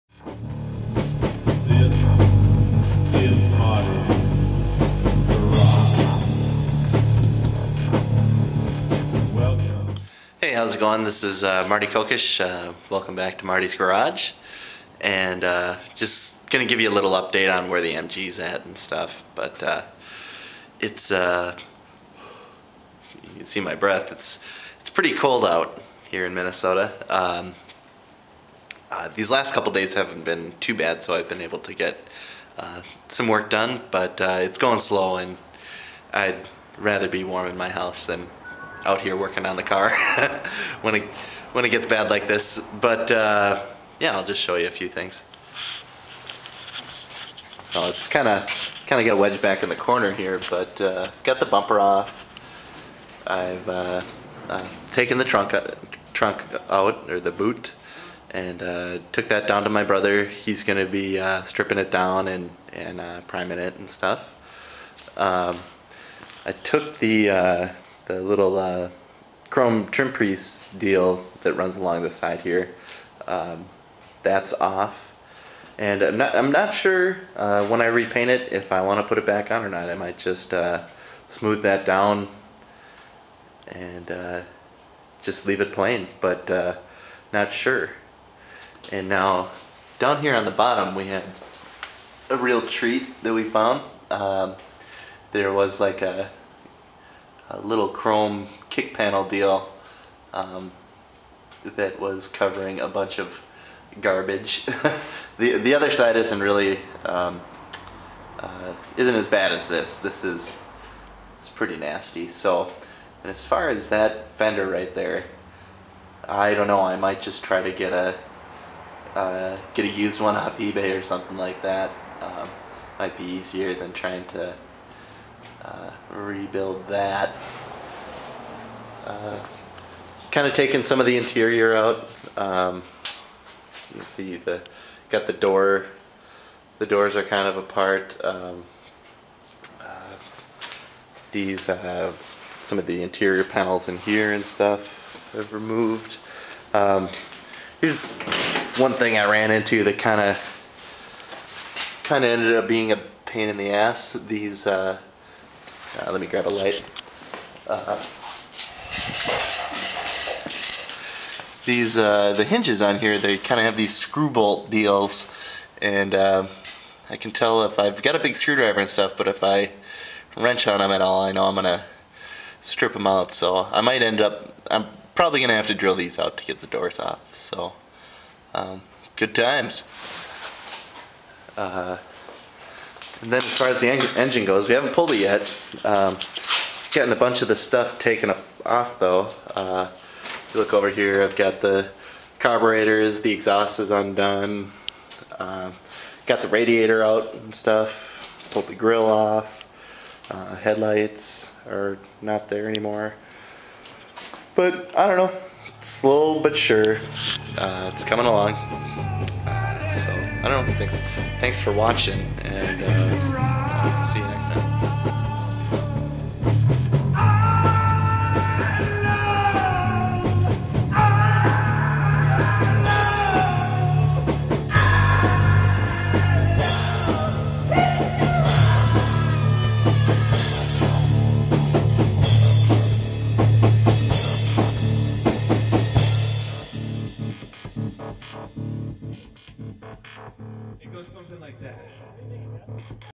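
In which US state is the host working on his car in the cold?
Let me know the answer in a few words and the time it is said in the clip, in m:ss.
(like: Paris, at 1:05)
Minnesota, at 0:26.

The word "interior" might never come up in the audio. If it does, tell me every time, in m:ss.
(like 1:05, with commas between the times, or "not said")
2:11, 2:23.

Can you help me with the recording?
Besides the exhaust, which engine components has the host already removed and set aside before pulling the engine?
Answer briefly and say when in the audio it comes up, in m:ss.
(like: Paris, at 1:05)
Carburetors, at 3:12.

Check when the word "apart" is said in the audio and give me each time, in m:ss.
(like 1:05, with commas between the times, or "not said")
2:17.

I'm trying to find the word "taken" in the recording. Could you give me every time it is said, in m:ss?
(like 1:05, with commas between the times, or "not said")
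0:54, 3:07.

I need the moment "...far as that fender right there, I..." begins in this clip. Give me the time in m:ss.
1:53.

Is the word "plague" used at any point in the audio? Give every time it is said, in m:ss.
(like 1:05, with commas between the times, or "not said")
not said.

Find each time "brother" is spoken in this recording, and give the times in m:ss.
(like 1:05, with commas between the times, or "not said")
0:59.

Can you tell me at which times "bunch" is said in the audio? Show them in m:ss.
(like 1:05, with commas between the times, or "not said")
1:42, 3:07.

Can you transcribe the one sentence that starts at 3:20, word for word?
Uh, headlights are not there anymore.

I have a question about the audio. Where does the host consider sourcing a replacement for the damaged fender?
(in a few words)
eBay.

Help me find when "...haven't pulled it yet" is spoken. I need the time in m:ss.
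3:04.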